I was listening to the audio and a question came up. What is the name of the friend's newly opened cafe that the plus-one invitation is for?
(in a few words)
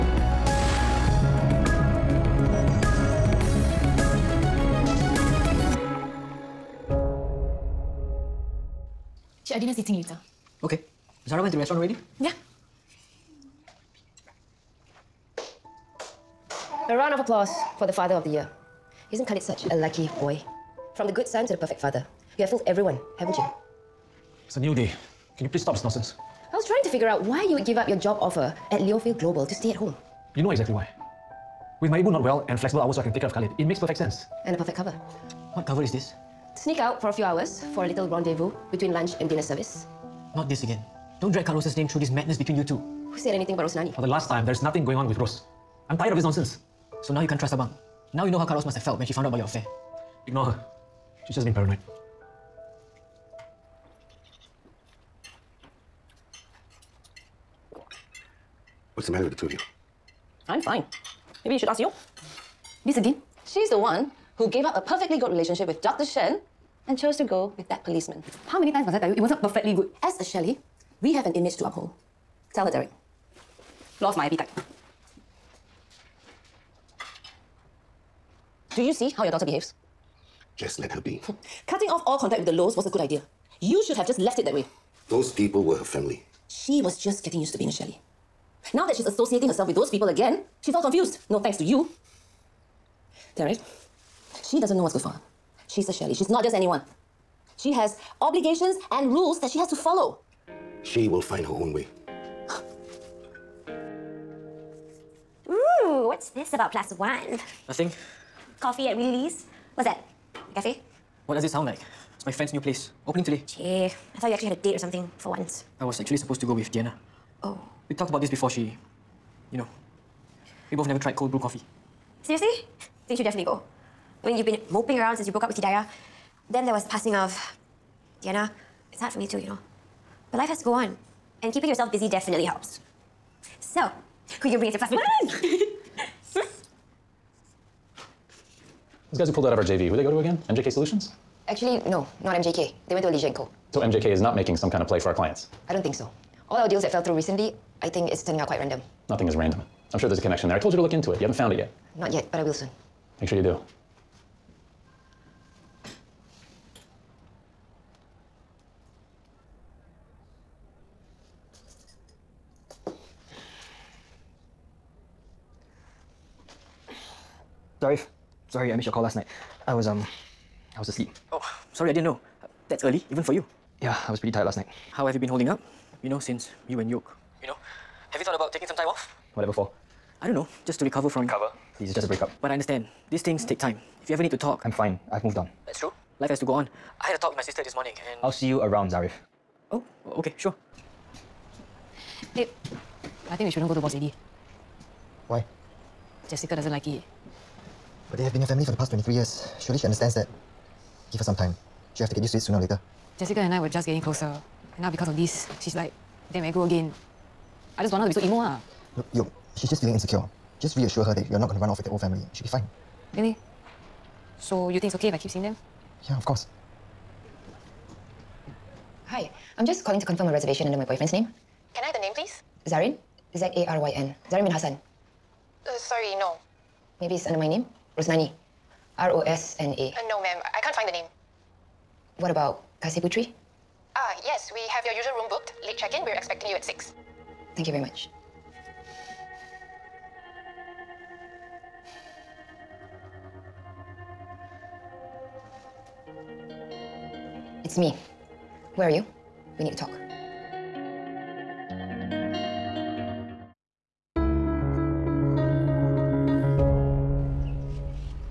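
Willy Lee's.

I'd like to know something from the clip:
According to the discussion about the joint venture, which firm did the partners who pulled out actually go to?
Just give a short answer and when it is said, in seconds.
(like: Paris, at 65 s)
Alicia and Co., at 143 s.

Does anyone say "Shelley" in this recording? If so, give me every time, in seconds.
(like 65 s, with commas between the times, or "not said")
70 s, 87 s, 95 s.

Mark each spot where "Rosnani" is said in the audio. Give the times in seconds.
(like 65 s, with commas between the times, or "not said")
43 s, 227 s.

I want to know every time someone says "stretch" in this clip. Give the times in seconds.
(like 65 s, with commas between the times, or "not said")
not said.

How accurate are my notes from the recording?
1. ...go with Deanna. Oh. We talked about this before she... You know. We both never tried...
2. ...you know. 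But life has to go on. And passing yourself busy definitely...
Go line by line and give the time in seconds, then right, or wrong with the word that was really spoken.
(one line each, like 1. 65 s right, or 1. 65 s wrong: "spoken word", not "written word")
1. 116 s right
2. 129 s wrong: "keeping", not "passing".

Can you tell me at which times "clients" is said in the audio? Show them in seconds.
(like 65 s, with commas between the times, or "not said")
145 s.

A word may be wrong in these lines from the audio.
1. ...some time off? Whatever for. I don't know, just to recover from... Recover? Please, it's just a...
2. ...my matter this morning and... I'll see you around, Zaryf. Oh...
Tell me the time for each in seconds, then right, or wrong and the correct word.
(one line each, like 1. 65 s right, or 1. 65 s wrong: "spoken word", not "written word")
1. 178 s right
2. 187 s wrong: "sister", not "matter".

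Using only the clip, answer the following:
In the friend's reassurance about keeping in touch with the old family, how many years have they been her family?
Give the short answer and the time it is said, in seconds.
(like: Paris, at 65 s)
23, at 198 s.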